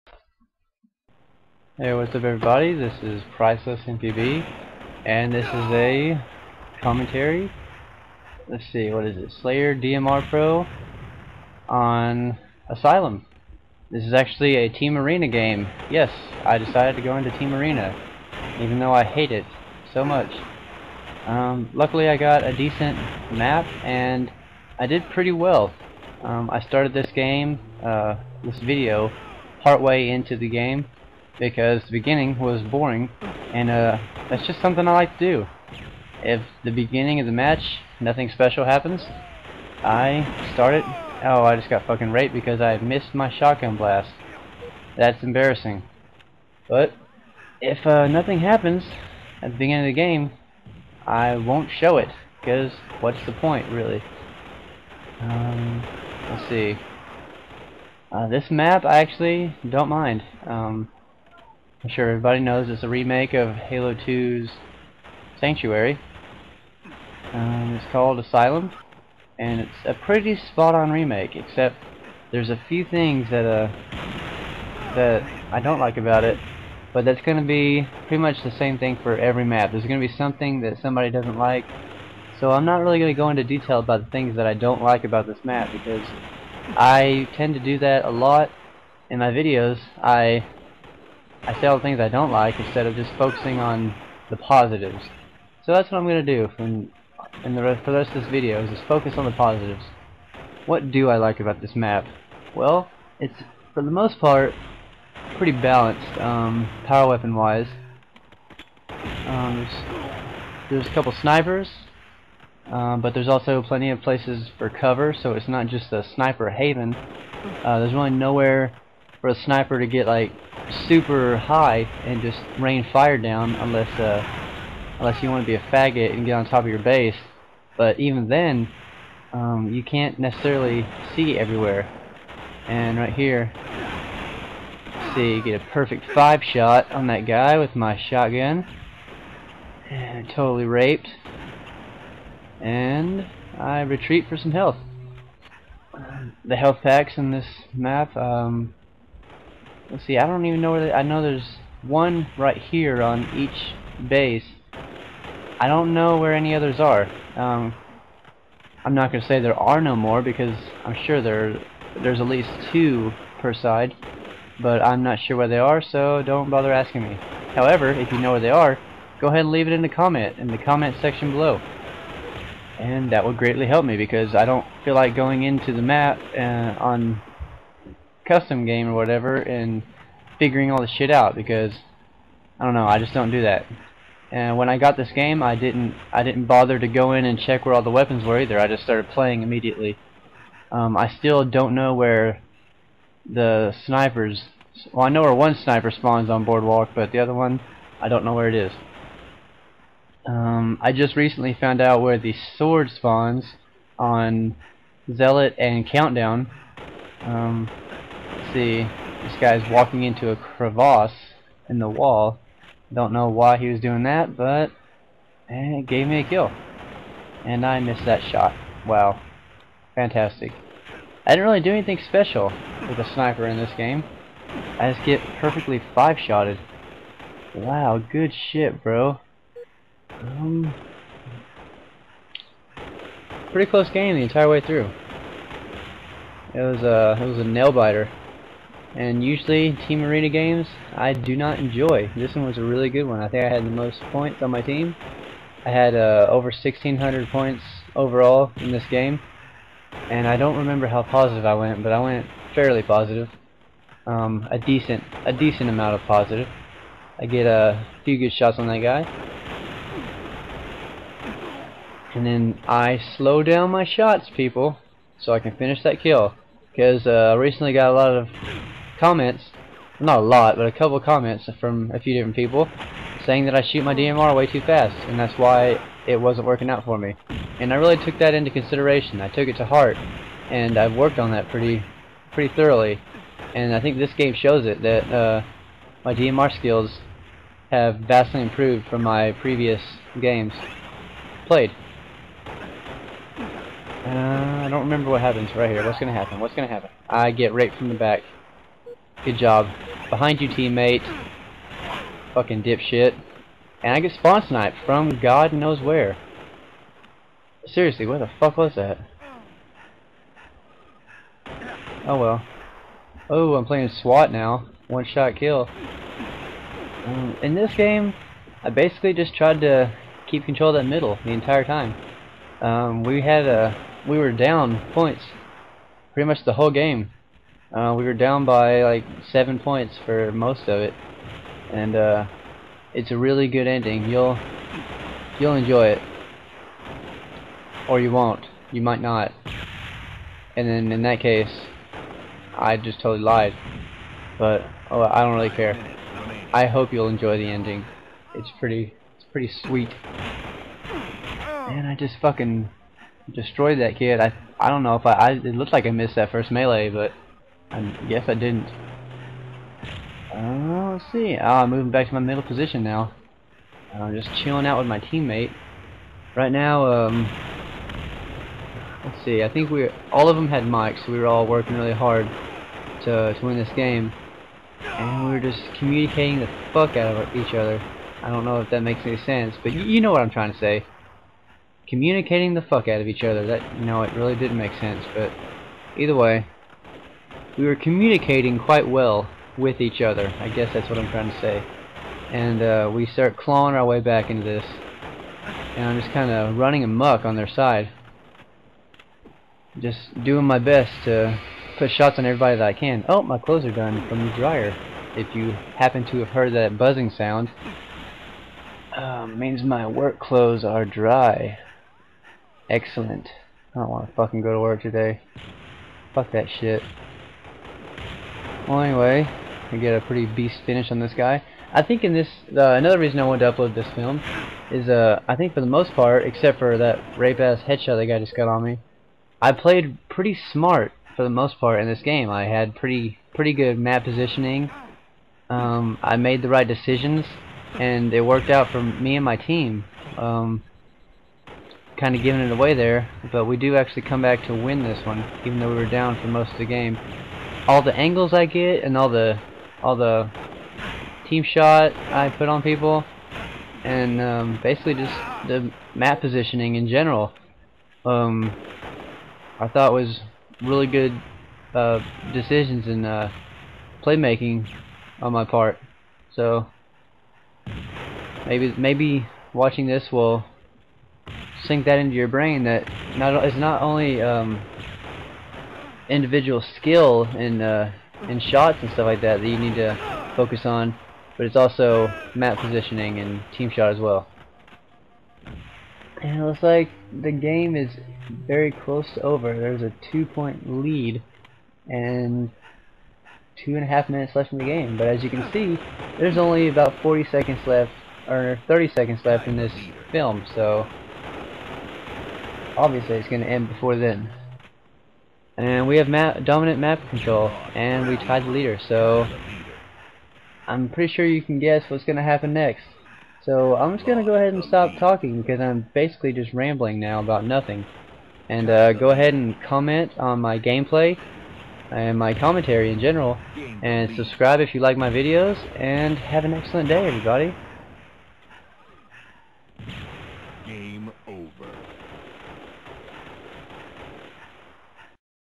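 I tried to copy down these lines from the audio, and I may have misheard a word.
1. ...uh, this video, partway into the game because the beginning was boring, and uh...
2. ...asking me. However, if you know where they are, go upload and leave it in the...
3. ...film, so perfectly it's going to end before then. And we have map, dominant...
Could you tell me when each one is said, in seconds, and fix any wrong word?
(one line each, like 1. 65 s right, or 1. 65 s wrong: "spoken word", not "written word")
1. 27 s right
2. 166 s wrong: "ahead", not "upload"
3. 500 s wrong: "obviously", not "perfectly".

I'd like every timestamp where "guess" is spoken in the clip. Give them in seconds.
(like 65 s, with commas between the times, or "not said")
358 s, 390 s, 511 s.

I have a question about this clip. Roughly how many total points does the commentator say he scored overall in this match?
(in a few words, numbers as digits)
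over 1600.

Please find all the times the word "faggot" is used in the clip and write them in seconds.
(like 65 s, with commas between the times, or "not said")
125 s.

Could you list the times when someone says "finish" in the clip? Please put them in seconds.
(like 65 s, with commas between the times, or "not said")
265 s, 420 s.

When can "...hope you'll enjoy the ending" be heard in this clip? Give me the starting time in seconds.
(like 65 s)
346 s.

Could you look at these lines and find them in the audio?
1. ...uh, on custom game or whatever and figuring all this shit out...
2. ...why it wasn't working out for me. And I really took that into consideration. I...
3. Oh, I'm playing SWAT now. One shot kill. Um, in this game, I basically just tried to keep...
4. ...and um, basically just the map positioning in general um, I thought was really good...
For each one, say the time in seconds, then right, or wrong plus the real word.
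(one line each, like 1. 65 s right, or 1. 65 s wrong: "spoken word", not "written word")
1. 176 s right
2. 275 s right
3. 313 s right
4. 453 s right.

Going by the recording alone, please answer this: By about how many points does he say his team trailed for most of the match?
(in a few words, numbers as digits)
7.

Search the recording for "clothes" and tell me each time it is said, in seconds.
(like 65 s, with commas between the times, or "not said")
403 s, 410 s.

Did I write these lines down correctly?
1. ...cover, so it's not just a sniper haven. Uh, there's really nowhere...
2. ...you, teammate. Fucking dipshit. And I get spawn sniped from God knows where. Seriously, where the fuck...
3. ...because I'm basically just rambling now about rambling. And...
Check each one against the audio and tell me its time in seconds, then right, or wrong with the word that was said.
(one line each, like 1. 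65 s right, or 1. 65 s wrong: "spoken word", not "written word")
1. 114 s right
2. 300 s right
3. 515 s wrong: "nothing", not "rambling".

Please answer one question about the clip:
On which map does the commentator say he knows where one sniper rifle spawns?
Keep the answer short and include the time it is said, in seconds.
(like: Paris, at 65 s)
Boardwalk, at 196 s.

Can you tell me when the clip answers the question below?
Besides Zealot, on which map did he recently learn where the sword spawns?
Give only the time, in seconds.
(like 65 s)
205 s.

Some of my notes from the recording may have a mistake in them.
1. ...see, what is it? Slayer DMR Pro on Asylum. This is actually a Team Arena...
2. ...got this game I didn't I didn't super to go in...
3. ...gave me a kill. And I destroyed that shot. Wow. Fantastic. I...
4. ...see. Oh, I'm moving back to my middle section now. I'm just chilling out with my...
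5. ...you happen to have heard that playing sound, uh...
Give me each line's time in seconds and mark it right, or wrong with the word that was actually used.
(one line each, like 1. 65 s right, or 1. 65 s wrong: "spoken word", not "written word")
1. 8 s right
2. 184 s wrong: "bother", not "super"
3. 215 s wrong: "missed", not "destroyed"
4. 361 s wrong: "position", not "section"
5. 405 s wrong: "buzzing", not "playing".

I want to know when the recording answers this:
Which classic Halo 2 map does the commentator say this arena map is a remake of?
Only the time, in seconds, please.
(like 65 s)
65 s.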